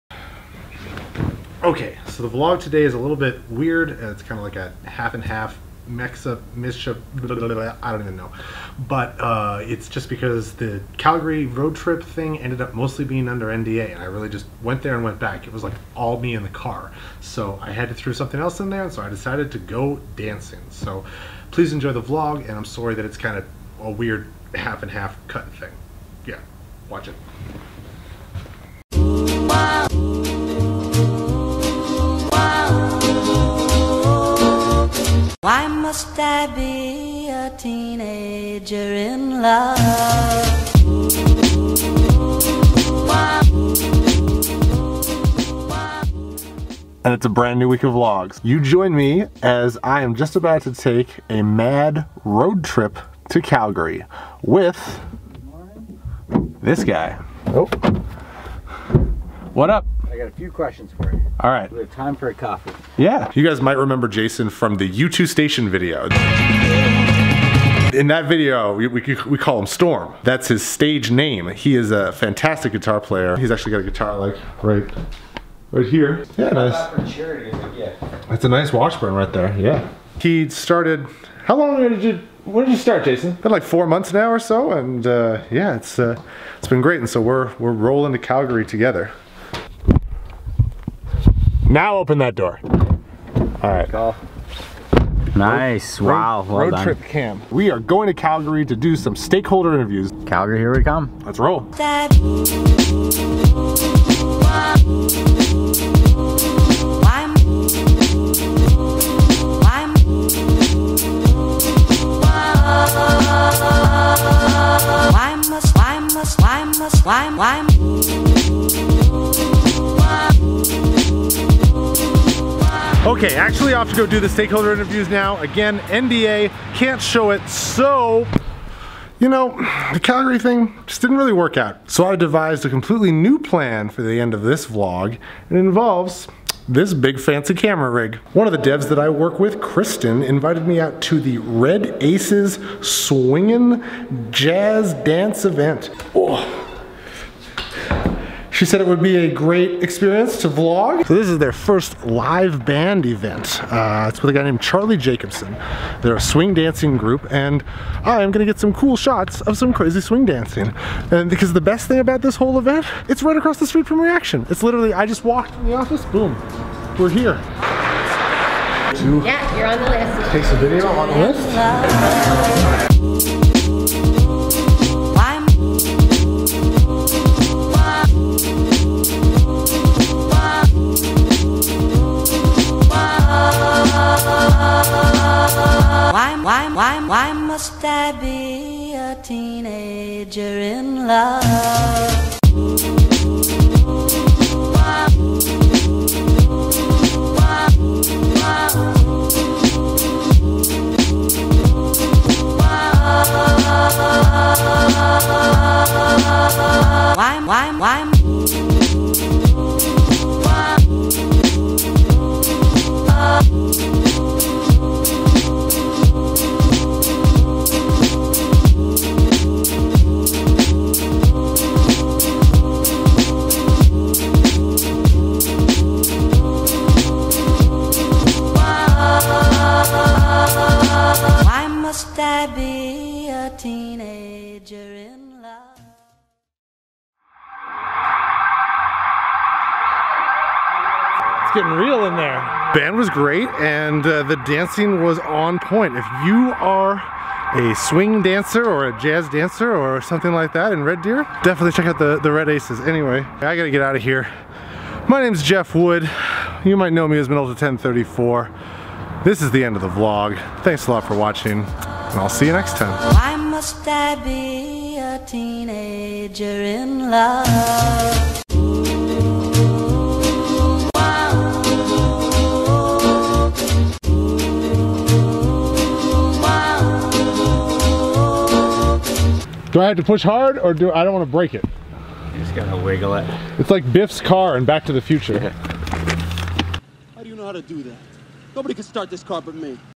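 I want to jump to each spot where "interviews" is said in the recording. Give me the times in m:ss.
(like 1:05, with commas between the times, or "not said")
1:39, 2:04.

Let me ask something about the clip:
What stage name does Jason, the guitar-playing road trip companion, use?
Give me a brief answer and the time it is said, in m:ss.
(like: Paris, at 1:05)
Storm, at 1:09.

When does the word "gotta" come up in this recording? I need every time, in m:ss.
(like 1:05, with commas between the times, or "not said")
4:13, 4:42.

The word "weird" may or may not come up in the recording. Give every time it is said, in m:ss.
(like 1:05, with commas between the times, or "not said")
0:03, 0:23.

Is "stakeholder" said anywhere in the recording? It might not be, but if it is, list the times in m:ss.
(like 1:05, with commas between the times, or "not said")
1:39, 2:04.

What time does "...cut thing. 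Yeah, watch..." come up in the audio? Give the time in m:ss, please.
0:25.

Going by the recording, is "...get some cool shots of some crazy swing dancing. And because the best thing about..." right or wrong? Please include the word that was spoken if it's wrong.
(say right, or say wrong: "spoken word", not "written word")
right.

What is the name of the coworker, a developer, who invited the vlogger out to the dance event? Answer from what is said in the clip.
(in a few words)
Kristen.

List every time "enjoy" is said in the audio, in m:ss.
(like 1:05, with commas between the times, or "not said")
0:21.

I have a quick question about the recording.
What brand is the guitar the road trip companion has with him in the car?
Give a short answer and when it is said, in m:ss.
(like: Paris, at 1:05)
Washburn, at 1:18.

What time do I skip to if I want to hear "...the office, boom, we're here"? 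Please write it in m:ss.
2:45.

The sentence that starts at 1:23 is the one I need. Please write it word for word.
Been like four months now or so, and uh, yeah, it's uh, it's been great.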